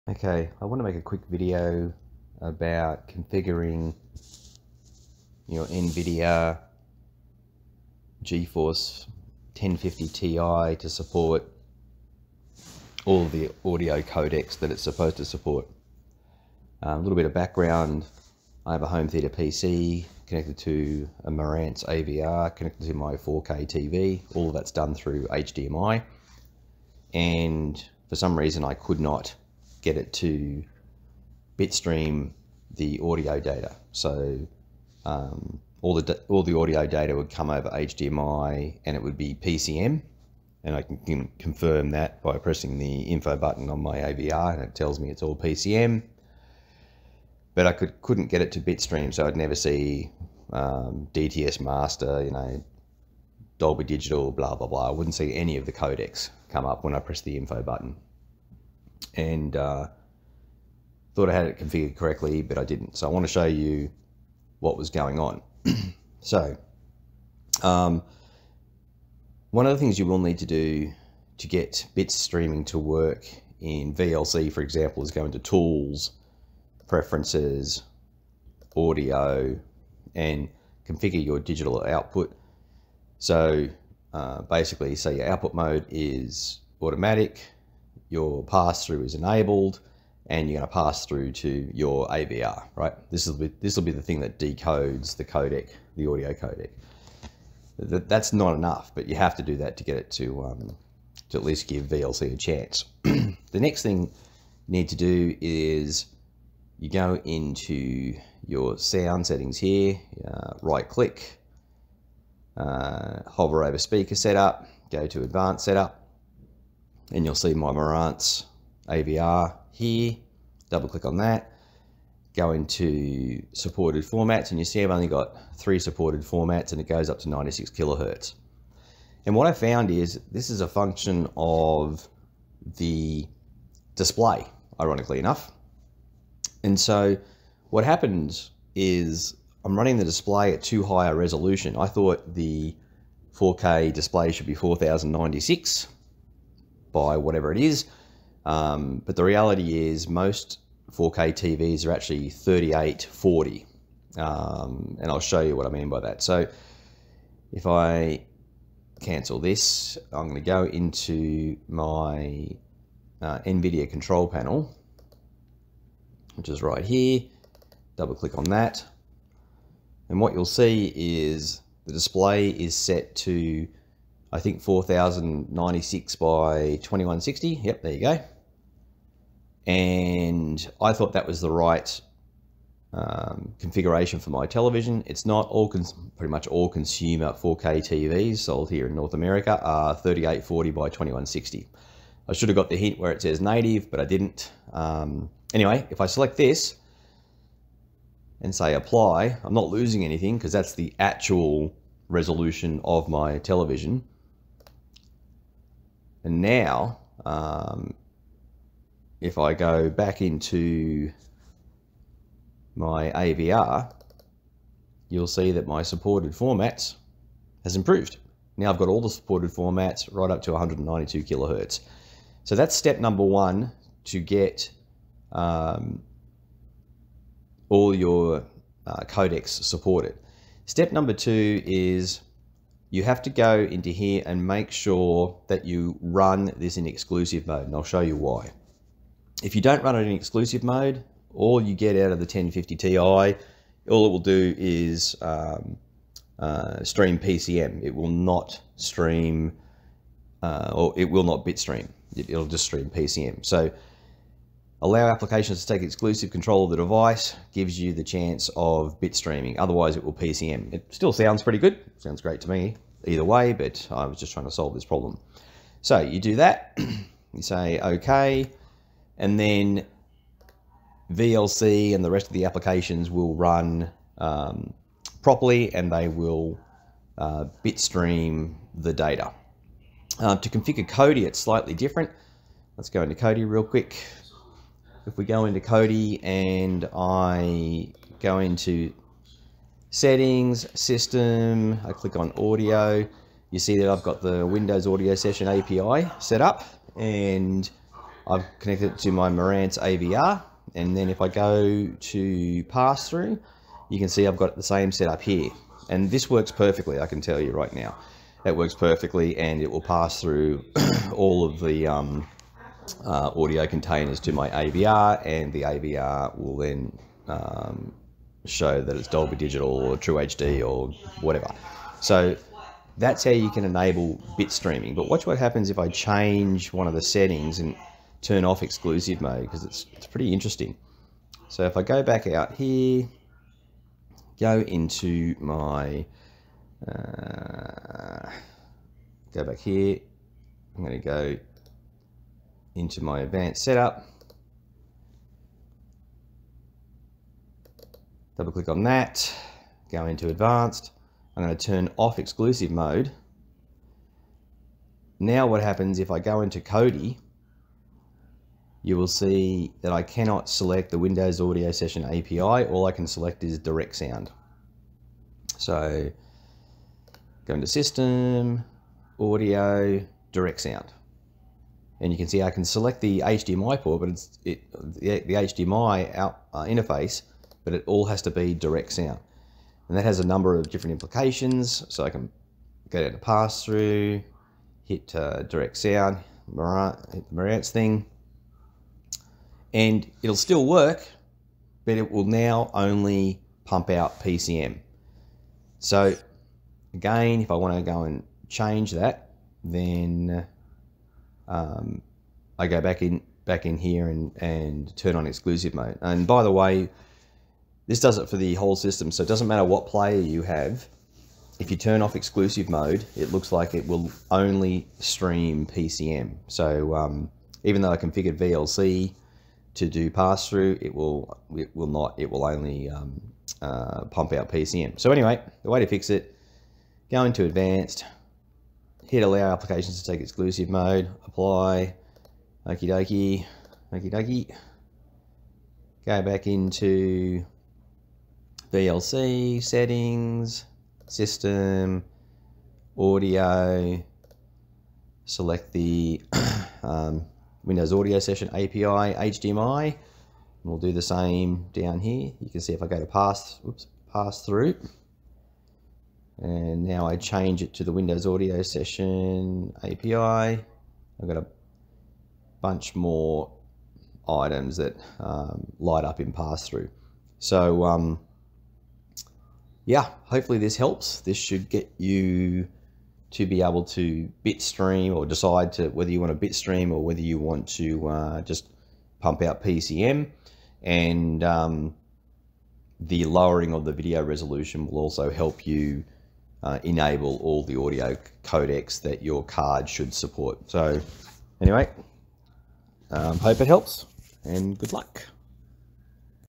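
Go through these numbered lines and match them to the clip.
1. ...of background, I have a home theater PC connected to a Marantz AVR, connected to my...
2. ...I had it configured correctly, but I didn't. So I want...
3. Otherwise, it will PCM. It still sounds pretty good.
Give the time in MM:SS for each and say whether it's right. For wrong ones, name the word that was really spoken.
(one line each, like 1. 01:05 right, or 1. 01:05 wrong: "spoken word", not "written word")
1. 00:17 right
2. 01:01 right
3. 04:19 right.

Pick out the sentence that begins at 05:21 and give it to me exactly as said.
So that's how you can enable bit streaming.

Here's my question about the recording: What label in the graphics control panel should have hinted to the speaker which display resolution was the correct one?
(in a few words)
native.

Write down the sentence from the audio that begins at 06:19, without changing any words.
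And that has a number of different implications.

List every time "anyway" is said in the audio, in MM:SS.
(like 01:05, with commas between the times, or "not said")
03:15, 07:05, 08:11.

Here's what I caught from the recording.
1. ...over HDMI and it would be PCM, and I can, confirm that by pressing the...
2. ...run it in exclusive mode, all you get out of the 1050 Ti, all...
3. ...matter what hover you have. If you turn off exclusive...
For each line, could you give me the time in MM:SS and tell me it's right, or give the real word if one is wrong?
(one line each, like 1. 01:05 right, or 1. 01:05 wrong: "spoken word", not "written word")
1. 00:37 right
2. 03:59 right
3. 06:49 wrong: "player", not "hover".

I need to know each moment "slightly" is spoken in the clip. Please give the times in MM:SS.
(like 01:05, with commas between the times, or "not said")
04:41.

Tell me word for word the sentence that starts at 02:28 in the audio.
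Um, but the reality is, most 4K TVs are actually 3840.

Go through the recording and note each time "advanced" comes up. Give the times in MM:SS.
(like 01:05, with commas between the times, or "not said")
01:55, 05:43, 05:50, 07:07.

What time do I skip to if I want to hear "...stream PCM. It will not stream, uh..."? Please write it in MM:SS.
04:06.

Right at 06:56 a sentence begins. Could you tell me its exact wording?
So um, even though I configured VLC to do pass through, it will it will not.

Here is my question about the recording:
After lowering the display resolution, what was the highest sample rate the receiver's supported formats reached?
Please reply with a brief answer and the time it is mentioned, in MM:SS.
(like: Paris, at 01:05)
192 kilohertz, at 03:40.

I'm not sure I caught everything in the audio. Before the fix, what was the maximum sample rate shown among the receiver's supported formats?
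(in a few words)
96 kilohertz.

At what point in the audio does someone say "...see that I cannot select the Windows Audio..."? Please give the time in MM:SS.
05:59.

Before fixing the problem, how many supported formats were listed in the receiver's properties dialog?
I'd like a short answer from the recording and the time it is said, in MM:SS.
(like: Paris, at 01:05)
3, at 02:05.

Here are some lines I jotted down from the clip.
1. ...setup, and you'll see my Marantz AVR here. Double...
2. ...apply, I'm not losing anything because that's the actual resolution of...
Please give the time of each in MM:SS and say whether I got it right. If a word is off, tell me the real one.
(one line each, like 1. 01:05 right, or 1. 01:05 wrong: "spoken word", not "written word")
1. 01:55 right
2. 03:18 right.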